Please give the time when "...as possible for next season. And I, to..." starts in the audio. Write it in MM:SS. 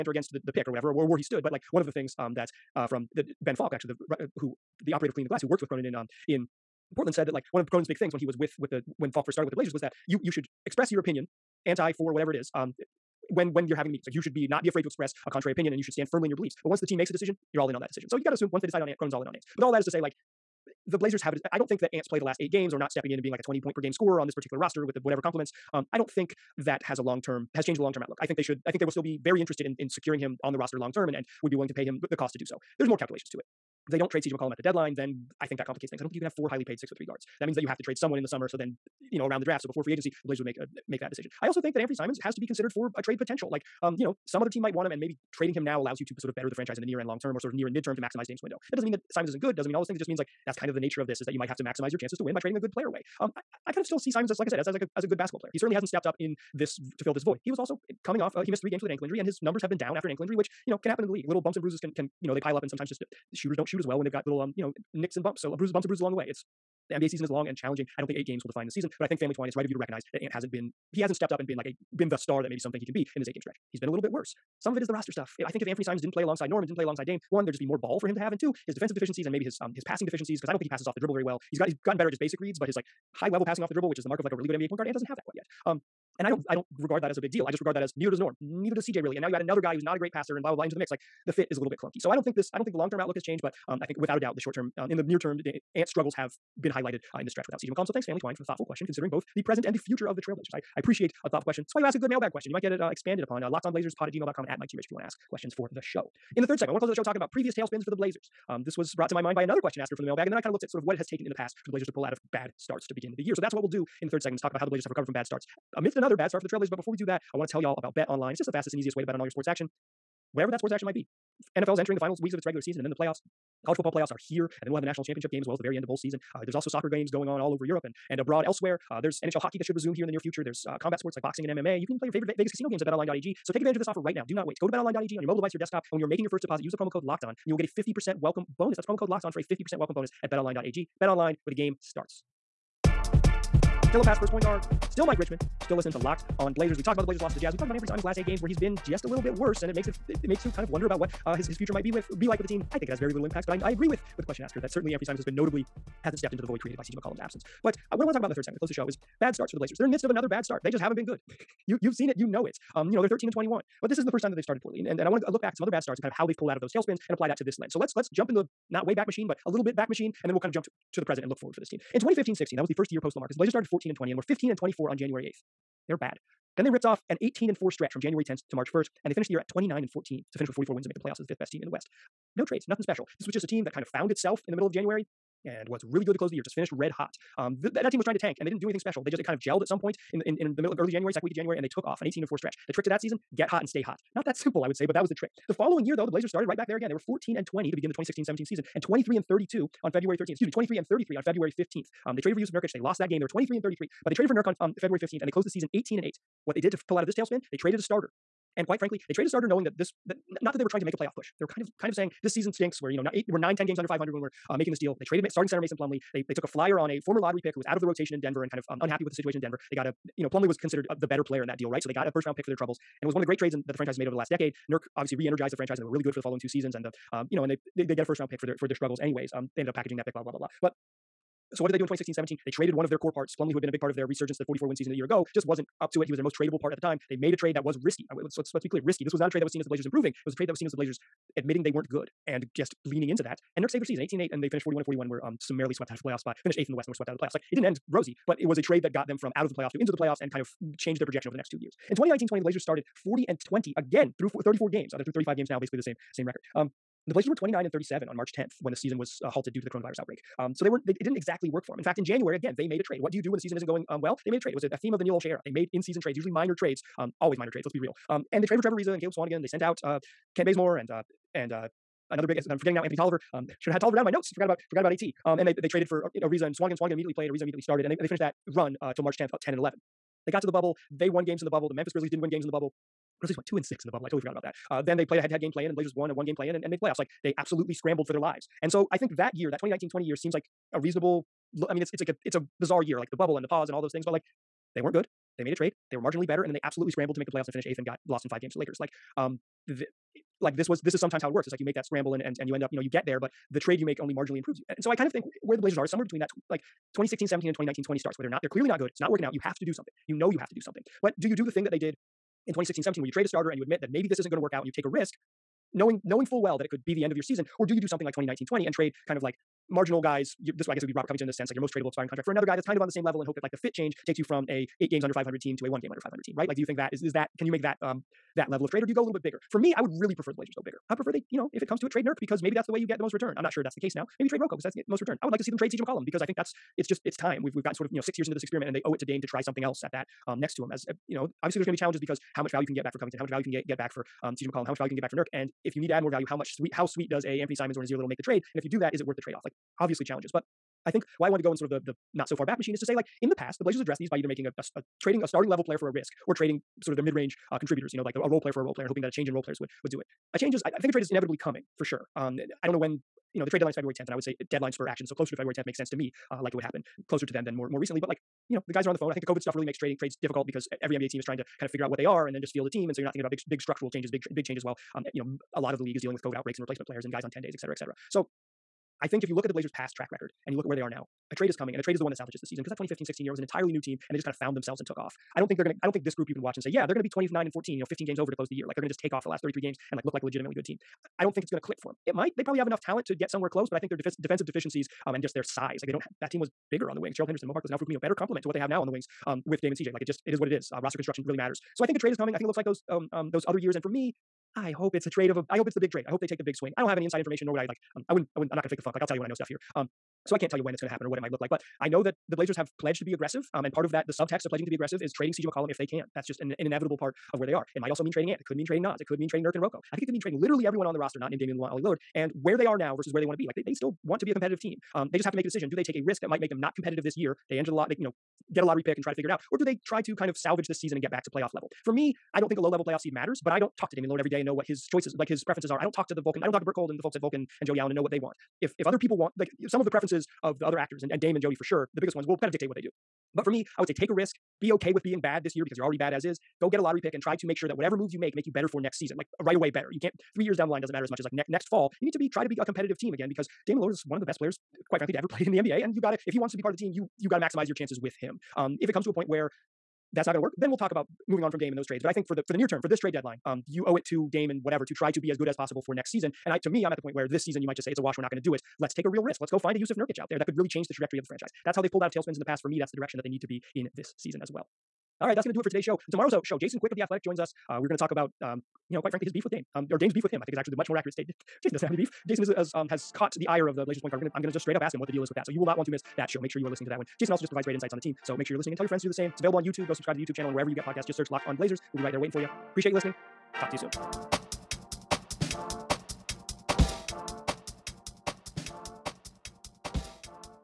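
07:45.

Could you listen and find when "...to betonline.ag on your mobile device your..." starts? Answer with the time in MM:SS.
02:14.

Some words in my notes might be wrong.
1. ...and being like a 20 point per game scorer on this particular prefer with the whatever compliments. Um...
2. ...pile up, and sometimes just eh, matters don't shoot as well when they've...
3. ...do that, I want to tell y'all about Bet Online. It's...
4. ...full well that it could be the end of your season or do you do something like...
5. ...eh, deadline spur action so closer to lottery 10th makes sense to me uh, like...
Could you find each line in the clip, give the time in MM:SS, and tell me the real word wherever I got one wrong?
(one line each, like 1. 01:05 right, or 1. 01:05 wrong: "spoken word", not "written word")
1. 00:23 wrong: "roster", not "prefer"
2. 01:02 wrong: "shooters", not "matters"
3. 01:56 right
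4. 05:16 right
5. 06:04 wrong: "february", not "lottery".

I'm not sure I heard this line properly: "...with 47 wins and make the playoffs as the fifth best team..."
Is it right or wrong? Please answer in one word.
wrong.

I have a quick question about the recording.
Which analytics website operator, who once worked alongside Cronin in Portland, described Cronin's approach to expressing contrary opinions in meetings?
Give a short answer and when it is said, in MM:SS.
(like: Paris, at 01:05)
Ben Falk, at 00:03.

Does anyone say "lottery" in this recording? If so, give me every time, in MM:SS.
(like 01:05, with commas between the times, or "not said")
03:37, 07:08, 07:26.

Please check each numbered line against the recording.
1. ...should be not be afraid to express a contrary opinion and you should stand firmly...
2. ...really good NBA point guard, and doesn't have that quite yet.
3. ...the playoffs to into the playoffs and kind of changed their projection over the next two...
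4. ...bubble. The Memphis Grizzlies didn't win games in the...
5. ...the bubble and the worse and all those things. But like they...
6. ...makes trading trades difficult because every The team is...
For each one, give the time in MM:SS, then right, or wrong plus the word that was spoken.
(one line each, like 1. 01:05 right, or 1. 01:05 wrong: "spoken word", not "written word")
1. 00:14 right
2. 01:24 right
3. 04:09 right
4. 04:41 right
5. 04:53 wrong: "pause", not "worse"
6. 06:09 wrong: "NBA", not "The".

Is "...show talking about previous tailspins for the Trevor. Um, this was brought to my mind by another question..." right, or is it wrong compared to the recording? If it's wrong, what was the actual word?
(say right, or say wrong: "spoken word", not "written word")
wrong: "Blazers", not "Trevor".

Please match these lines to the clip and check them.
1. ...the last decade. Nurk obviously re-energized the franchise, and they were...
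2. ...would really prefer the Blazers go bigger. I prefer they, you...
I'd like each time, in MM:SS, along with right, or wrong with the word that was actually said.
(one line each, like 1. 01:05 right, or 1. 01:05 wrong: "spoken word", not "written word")
1. 03:44 right
2. 05:29 right.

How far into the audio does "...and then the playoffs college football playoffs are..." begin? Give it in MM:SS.
02:02.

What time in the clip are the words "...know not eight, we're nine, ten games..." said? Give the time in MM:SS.
03:32.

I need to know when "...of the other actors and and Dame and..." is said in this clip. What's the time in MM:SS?
07:20.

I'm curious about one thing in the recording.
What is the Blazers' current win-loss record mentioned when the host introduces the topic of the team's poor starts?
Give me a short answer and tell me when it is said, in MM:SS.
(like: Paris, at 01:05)
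13-21, at 02:43.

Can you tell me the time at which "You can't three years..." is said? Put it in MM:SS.
07:29.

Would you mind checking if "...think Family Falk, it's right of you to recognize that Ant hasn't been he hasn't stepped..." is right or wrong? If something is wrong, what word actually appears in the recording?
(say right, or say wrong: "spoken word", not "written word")
wrong: "Twine", not "Falk".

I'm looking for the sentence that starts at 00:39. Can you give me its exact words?
So before free agency, the Blazers would make make that decision.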